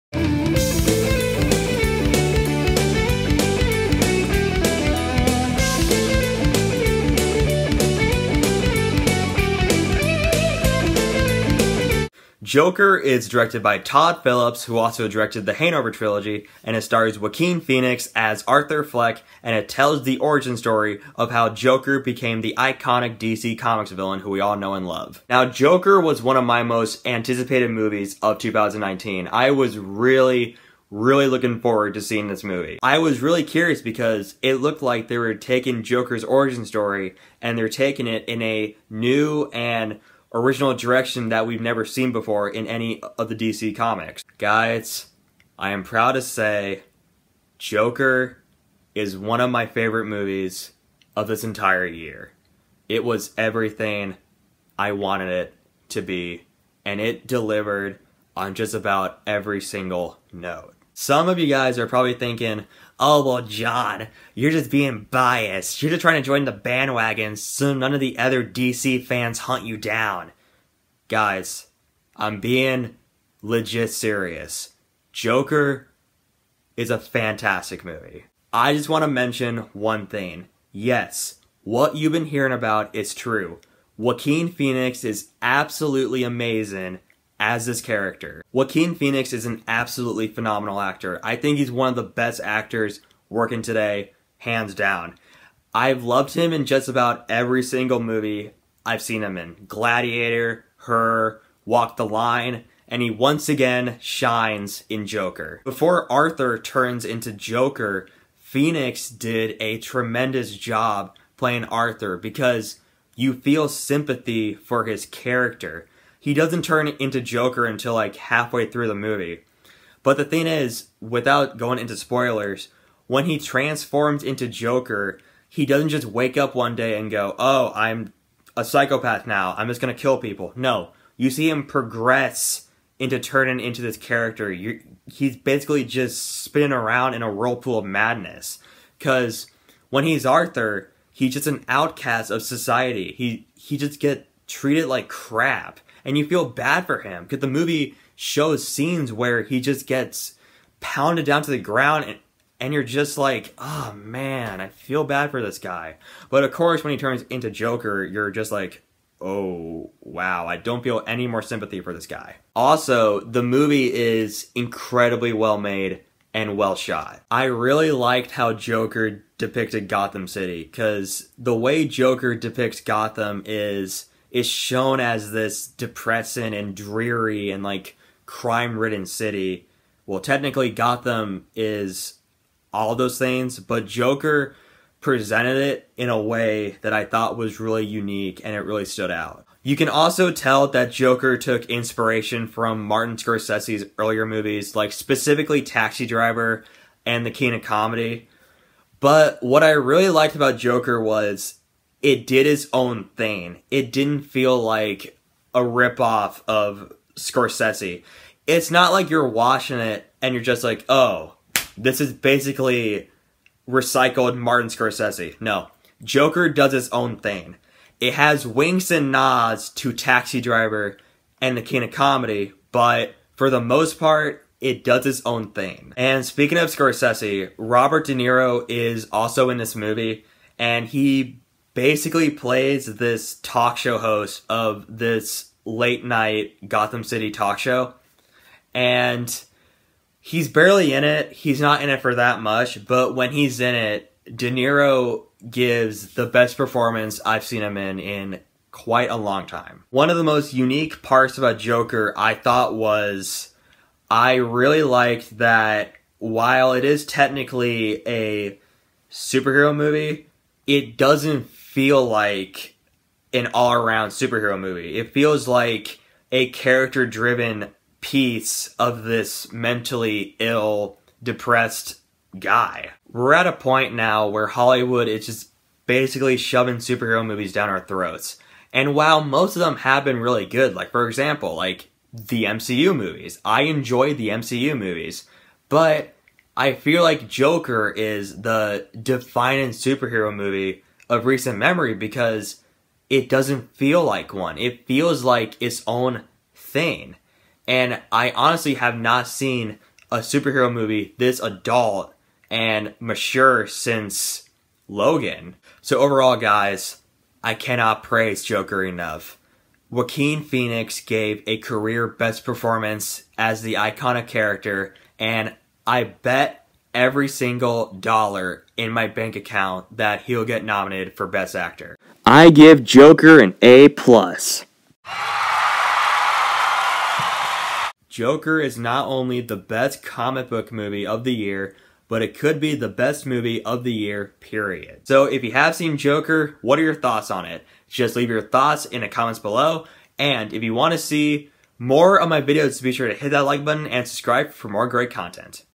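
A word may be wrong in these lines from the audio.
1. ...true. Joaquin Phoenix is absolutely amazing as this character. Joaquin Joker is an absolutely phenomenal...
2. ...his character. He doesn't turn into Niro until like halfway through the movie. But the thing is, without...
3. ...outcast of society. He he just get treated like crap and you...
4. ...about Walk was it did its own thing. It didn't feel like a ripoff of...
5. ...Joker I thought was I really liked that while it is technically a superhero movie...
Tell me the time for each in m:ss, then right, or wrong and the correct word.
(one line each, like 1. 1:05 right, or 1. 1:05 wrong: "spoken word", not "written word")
1. 1:23 wrong: "Phoenix", not "Joker"
2. 1:54 wrong: "Joker", not "Niro"
3. 2:21 right
4. 3:20 wrong: "Joker", not "Walk"
5. 4:11 right.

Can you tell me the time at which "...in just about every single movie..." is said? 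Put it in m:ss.
1:36.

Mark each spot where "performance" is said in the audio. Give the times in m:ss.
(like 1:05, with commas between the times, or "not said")
4:06, 5:12.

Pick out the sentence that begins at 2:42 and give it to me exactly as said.
Also, the movie is incredibly well made and well shot.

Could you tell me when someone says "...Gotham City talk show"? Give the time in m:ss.
3:56.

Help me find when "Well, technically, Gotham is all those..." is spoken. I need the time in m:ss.
3:00.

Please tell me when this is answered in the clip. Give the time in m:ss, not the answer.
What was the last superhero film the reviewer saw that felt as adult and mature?
5:04.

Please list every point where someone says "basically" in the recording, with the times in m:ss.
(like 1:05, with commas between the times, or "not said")
2:15, 3:32, 3:51, 4:35.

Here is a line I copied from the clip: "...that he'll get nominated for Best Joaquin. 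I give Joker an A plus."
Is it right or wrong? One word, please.
wrong.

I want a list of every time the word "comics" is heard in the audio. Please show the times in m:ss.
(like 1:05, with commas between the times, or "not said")
0:23, 0:43, 5:30.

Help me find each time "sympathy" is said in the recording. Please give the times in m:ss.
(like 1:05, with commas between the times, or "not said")
1:53, 2:41.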